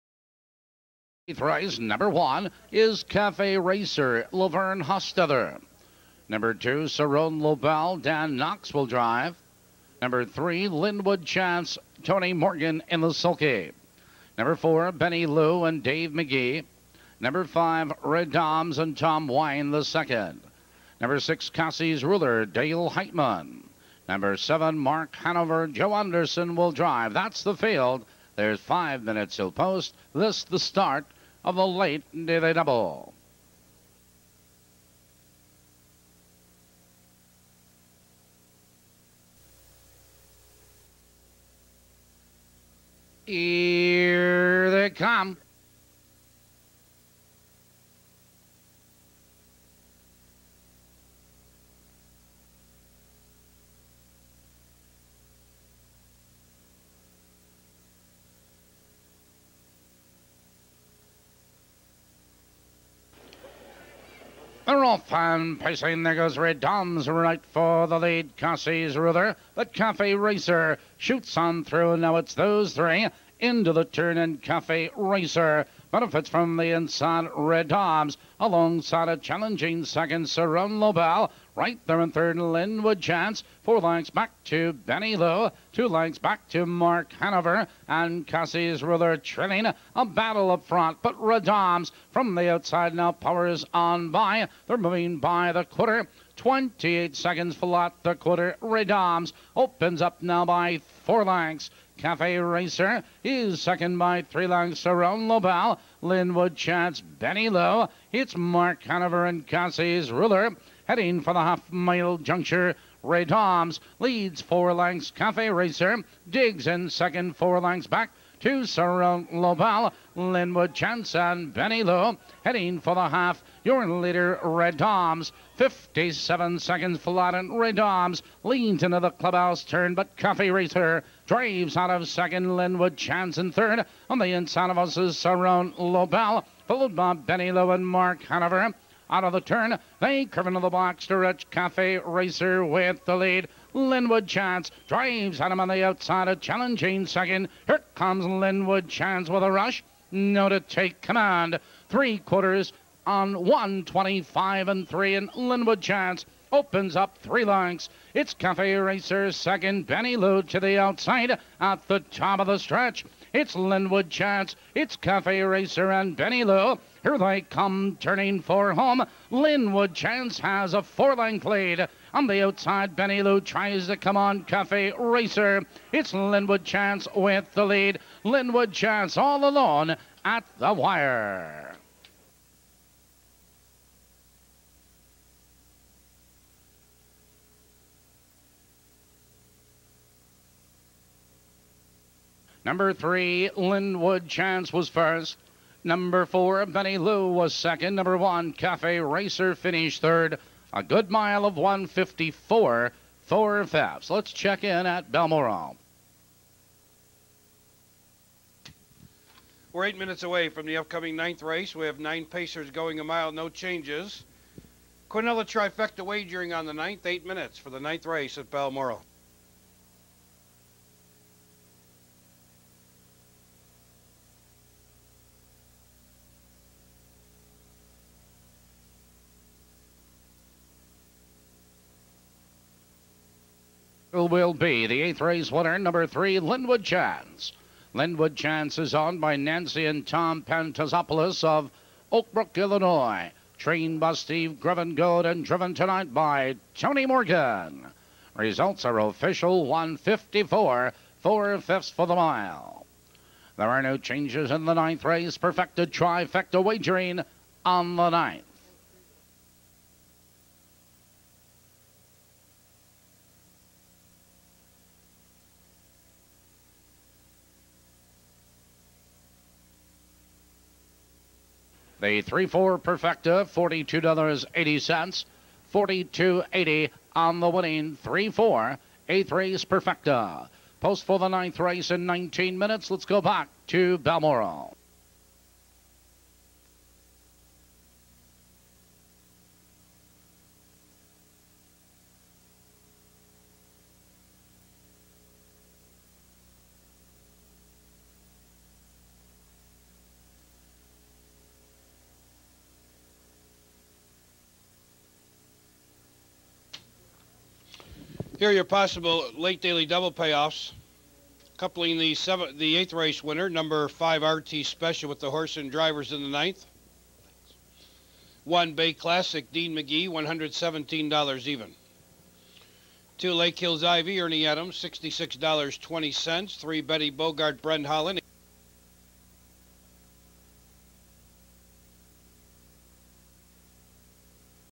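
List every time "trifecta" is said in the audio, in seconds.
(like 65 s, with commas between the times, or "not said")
215 s, 255 s.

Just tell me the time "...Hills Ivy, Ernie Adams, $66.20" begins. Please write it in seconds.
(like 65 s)
323 s.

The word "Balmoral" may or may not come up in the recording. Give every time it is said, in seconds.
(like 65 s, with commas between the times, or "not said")
205 s, 218 s, 283 s.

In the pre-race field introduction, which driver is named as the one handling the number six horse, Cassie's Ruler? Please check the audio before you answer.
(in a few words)
Dale Heitman.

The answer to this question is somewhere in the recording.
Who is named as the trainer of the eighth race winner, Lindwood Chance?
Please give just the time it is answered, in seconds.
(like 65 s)
244 s.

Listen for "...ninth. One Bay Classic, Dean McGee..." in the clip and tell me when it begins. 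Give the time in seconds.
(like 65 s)
316 s.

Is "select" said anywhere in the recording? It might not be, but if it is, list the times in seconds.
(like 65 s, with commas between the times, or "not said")
not said.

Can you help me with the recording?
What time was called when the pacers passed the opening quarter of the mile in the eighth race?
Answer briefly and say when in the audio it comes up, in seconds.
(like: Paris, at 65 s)
28 seconds, at 96 s.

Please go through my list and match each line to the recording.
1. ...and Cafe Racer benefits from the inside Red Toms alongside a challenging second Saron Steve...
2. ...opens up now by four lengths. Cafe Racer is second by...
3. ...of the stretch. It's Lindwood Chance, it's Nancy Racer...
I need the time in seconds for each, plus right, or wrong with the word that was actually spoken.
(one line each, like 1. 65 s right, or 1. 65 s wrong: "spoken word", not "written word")
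1. 74 s wrong: "Lobel", not "Steve"
2. 99 s right
3. 162 s wrong: "Cafe", not "Nancy".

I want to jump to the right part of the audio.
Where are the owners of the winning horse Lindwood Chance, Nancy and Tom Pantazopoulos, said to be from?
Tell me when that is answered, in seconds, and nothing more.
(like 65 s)
242 s.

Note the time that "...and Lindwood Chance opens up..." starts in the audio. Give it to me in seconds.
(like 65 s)
155 s.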